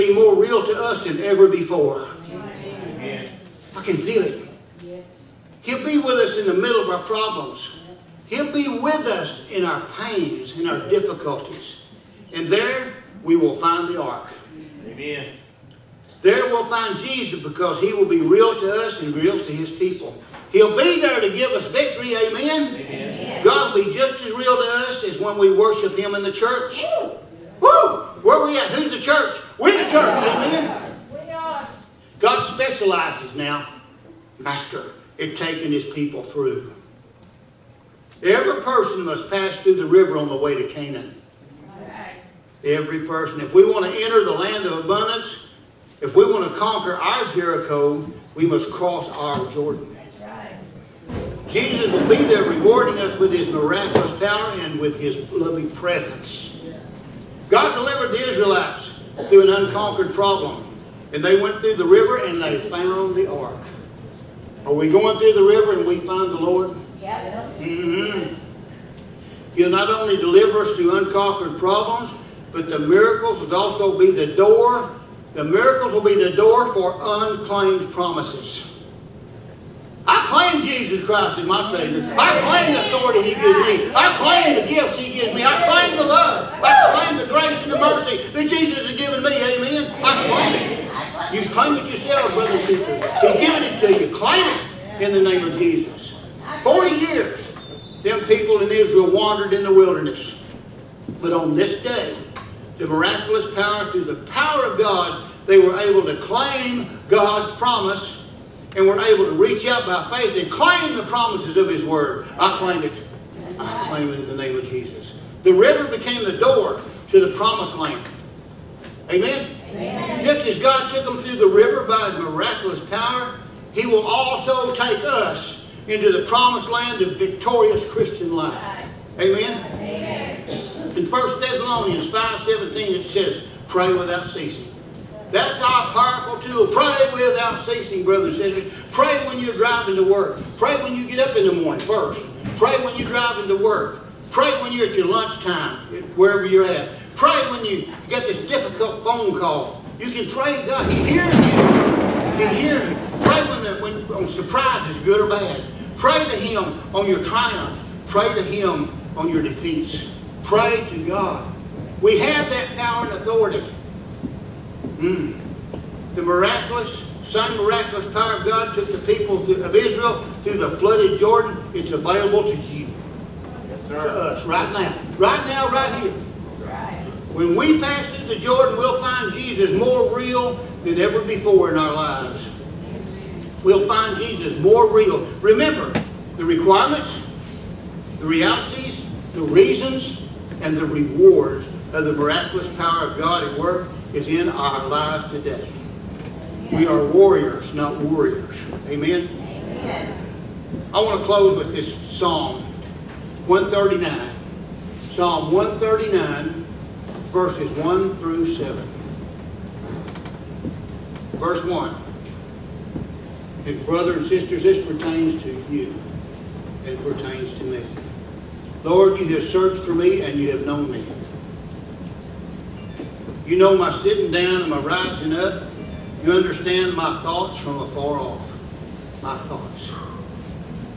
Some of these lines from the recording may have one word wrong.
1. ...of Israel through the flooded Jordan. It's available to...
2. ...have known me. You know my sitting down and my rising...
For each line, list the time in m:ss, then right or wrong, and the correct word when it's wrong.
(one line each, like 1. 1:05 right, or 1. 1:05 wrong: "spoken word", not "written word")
1. 2:49 right
2. 3:40 right.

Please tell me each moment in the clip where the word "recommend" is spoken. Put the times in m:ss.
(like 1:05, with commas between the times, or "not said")
not said.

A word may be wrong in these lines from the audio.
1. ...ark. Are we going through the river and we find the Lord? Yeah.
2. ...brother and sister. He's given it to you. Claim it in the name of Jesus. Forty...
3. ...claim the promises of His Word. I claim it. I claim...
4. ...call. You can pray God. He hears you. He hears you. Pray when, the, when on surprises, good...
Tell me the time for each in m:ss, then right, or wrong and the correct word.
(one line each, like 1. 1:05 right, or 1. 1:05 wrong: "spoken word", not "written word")
1. 1:03 right
2. 1:32 right
3. 1:50 right
4. 2:29 right.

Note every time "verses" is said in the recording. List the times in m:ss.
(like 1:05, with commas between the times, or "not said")
3:27, 3:31.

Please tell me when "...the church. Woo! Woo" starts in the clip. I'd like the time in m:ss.
0:26.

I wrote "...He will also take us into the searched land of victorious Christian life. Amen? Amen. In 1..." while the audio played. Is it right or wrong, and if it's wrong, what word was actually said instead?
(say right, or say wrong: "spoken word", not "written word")
wrong: "promised", not "searched".